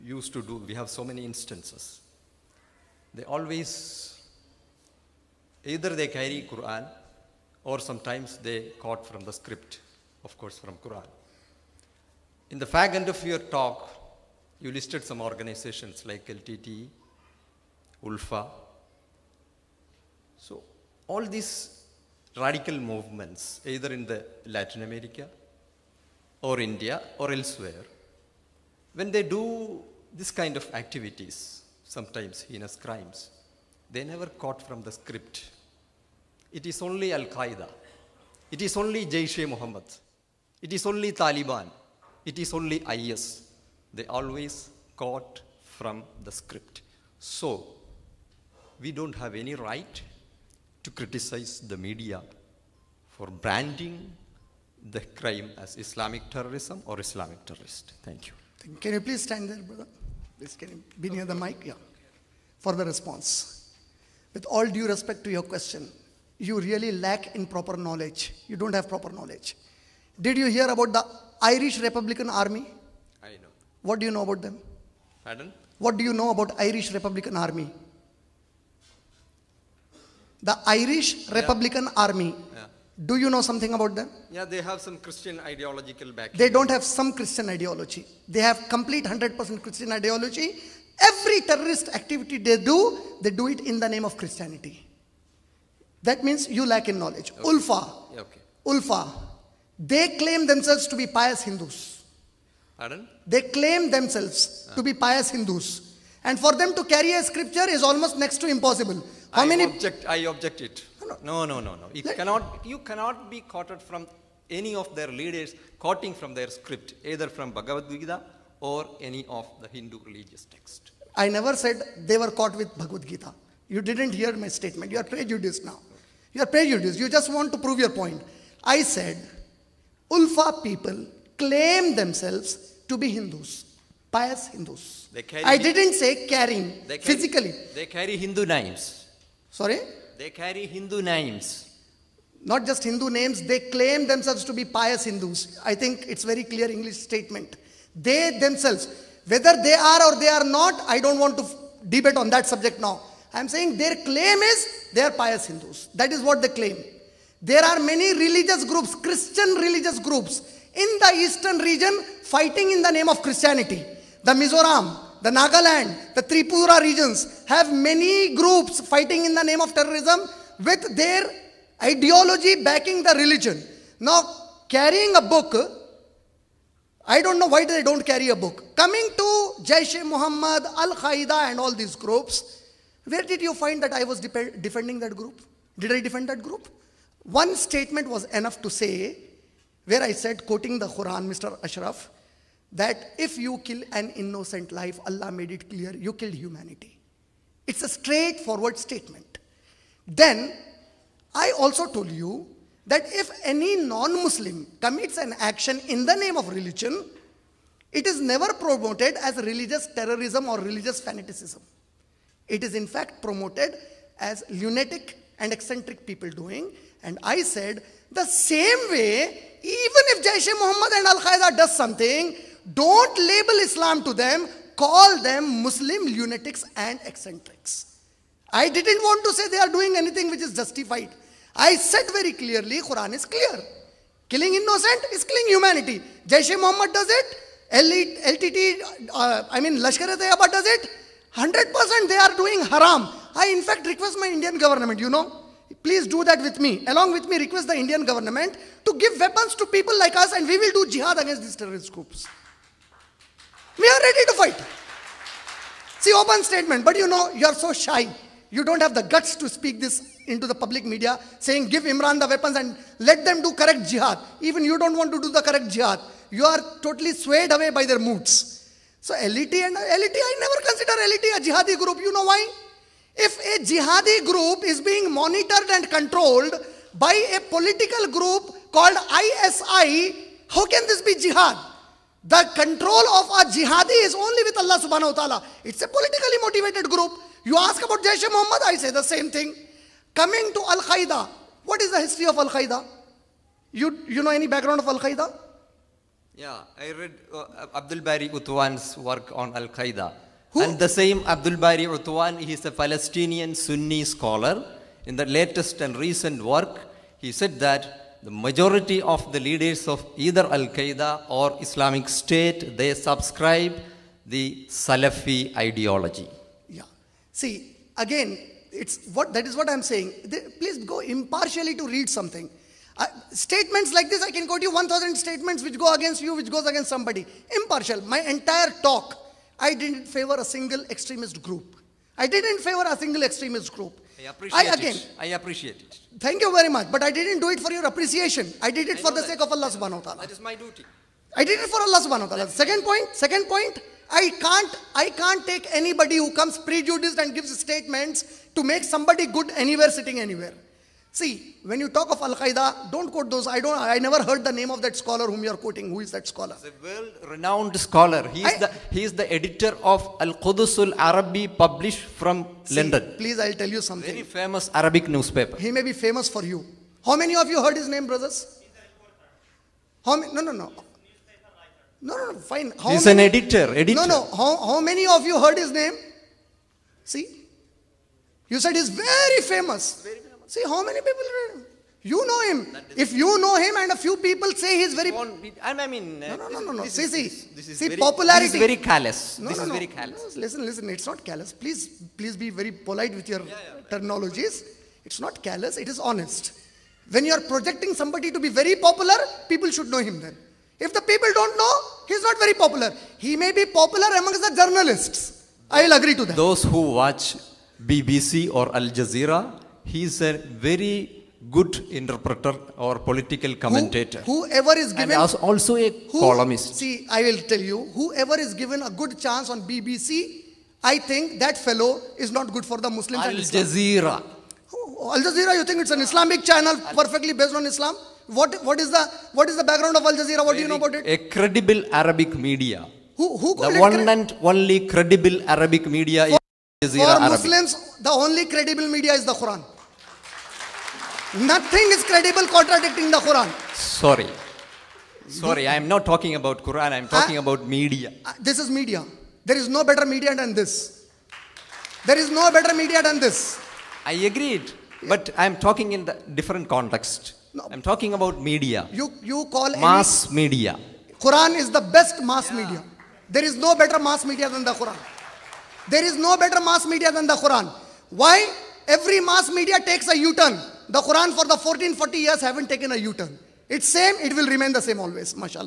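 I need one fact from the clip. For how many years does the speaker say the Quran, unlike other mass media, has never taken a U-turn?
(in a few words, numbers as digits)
1440.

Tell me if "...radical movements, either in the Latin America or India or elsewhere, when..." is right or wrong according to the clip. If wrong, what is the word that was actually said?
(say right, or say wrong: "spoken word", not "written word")
right.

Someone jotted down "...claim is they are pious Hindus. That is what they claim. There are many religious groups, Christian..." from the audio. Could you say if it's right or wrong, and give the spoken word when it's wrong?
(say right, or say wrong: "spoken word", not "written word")
right.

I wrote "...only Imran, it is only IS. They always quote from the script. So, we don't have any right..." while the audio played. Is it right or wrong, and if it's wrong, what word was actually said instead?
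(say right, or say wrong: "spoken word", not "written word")
wrong: "Taliban", not "Imran".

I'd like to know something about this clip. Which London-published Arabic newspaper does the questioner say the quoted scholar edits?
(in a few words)
Al Qudusul Arabi.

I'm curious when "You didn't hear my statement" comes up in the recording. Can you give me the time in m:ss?
2:03.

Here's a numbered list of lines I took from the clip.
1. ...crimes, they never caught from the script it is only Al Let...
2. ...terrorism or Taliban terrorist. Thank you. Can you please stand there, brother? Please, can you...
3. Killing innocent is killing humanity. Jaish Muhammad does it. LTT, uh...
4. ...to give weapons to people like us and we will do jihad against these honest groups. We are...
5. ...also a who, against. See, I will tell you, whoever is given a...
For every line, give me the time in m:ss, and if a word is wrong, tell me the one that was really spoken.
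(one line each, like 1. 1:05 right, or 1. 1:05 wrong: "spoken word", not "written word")
1. 0:32 wrong: "Qaeda", not "Let"
2. 0:56 wrong: "Islamic", not "Taliban"
3. 3:54 right
4. 4:08 wrong: "terrorist", not "honest"
5. 6:55 wrong: "columnist", not "against".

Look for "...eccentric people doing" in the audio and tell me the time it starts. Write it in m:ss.
3:35.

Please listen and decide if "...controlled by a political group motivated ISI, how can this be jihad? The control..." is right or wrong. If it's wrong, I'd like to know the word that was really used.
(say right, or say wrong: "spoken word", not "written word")
wrong: "called", not "motivated".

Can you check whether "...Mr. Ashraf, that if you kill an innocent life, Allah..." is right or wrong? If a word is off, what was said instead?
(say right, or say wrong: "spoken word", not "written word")
right.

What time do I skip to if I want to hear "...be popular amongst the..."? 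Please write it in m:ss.
6:43.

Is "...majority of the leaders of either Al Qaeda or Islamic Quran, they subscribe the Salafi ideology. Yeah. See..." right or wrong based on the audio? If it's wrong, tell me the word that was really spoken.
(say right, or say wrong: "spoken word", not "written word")
wrong: "State", not "Quran".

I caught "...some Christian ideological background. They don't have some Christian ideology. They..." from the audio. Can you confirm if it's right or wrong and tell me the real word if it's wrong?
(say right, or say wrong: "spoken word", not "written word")
right.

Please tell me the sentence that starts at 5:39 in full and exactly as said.
sake of Allah subhanahu wa ta'ala.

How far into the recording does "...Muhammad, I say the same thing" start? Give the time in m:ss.
4:48.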